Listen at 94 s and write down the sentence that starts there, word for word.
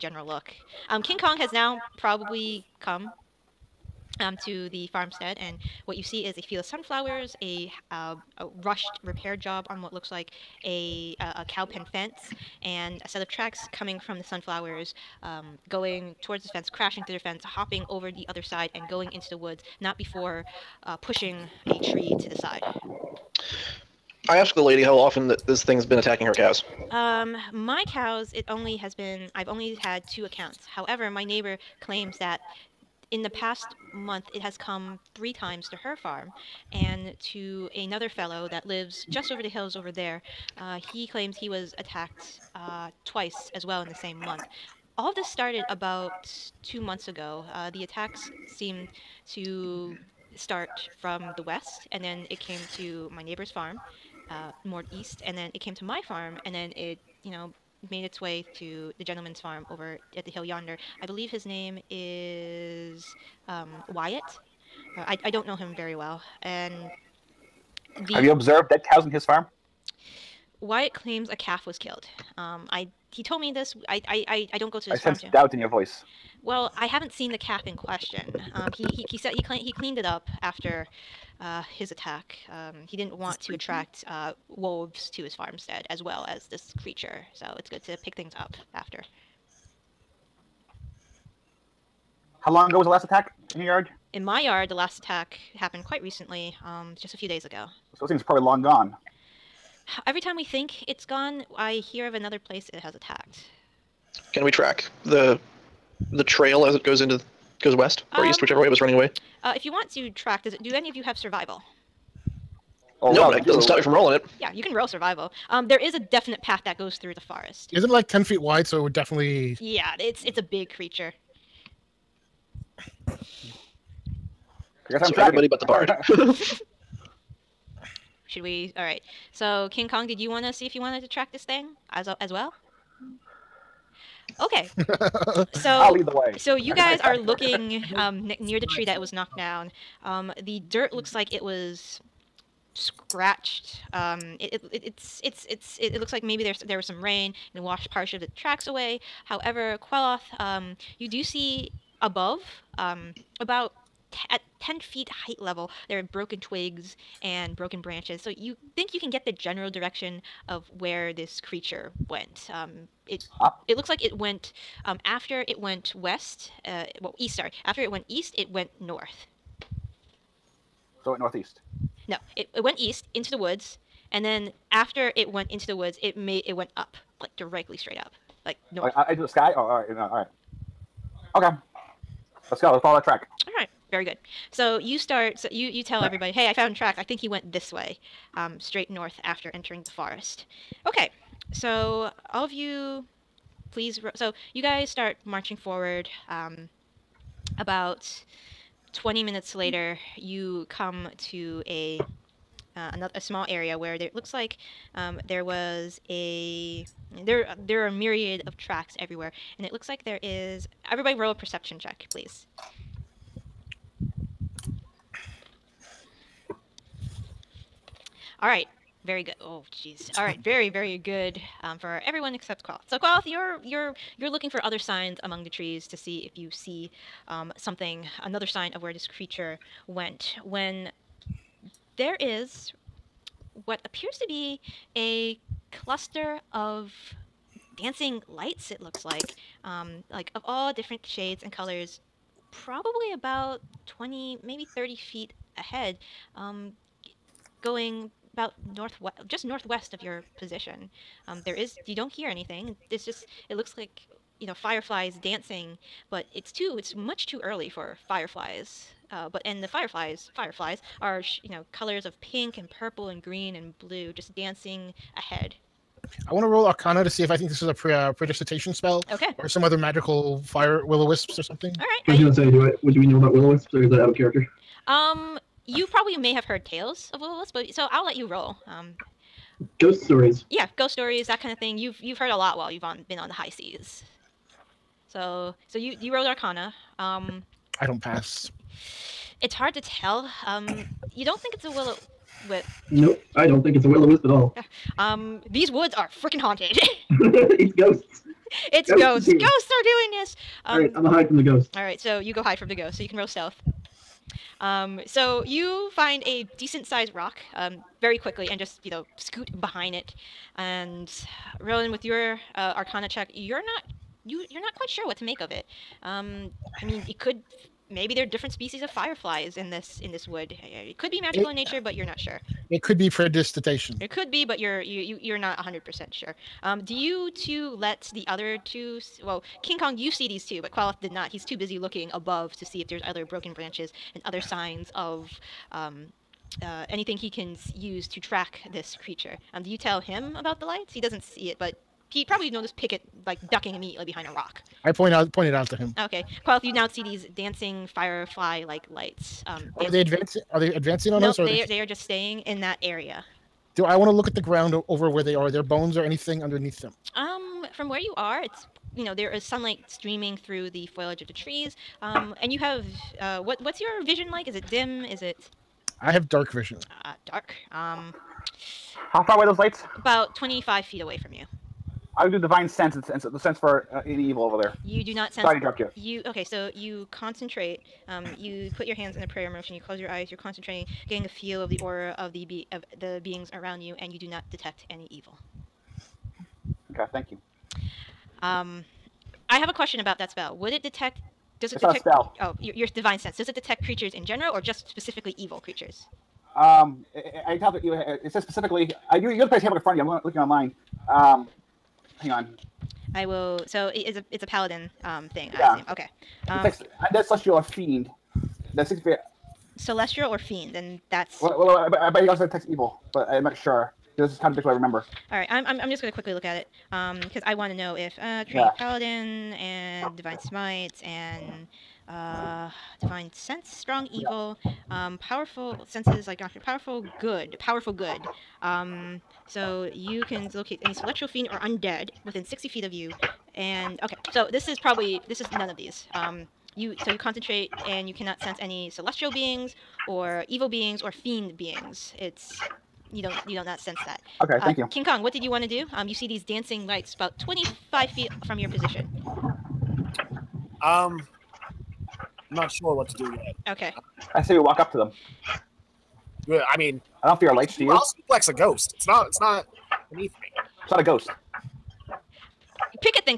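In my yard, the last attack happened quite recently, um, just a few days ago.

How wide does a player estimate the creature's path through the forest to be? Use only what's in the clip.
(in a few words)
10 feet.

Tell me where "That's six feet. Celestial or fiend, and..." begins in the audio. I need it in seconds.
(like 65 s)
408 s.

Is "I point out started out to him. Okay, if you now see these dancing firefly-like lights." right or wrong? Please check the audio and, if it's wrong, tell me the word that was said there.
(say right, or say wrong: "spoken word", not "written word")
wrong: "pointed", not "started".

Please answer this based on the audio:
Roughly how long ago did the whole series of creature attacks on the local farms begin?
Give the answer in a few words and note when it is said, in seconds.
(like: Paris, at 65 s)
2 months ago, at 45 s.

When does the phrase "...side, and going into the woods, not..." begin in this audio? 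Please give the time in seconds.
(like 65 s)
18 s.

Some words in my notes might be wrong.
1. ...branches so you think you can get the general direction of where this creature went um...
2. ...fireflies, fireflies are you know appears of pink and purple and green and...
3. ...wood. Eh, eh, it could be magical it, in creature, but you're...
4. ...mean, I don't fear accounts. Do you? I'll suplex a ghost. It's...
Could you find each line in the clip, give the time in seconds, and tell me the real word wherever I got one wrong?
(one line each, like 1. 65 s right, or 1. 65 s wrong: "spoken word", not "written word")
1. 157 s right
2. 259 s wrong: "colors", not "appears"
3. 320 s wrong: "nature", not "creature"
4. 456 s wrong: "lights", not "accounts".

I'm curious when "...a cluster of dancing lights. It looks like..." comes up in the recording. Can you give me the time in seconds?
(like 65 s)
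234 s.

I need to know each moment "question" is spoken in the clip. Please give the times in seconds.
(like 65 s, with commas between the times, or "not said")
77 s, 389 s.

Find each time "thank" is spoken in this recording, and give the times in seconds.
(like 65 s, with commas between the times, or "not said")
387 s, 444 s.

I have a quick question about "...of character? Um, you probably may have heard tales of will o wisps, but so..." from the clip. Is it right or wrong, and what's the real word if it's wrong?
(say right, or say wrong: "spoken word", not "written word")
right.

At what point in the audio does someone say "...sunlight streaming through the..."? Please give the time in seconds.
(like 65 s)
359 s.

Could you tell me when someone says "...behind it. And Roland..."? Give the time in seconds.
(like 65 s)
309 s.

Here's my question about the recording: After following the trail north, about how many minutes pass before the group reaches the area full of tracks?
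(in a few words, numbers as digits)
20 minutes.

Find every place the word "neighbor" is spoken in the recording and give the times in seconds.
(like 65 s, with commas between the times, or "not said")
31 s, 53 s.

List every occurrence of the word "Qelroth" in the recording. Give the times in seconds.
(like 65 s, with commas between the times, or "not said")
149 s, 330 s.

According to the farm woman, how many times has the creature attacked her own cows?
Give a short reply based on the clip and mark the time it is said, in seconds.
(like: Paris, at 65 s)
2, at 29 s.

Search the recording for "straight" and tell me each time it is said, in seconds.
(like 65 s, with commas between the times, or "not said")
177 s, 188 s.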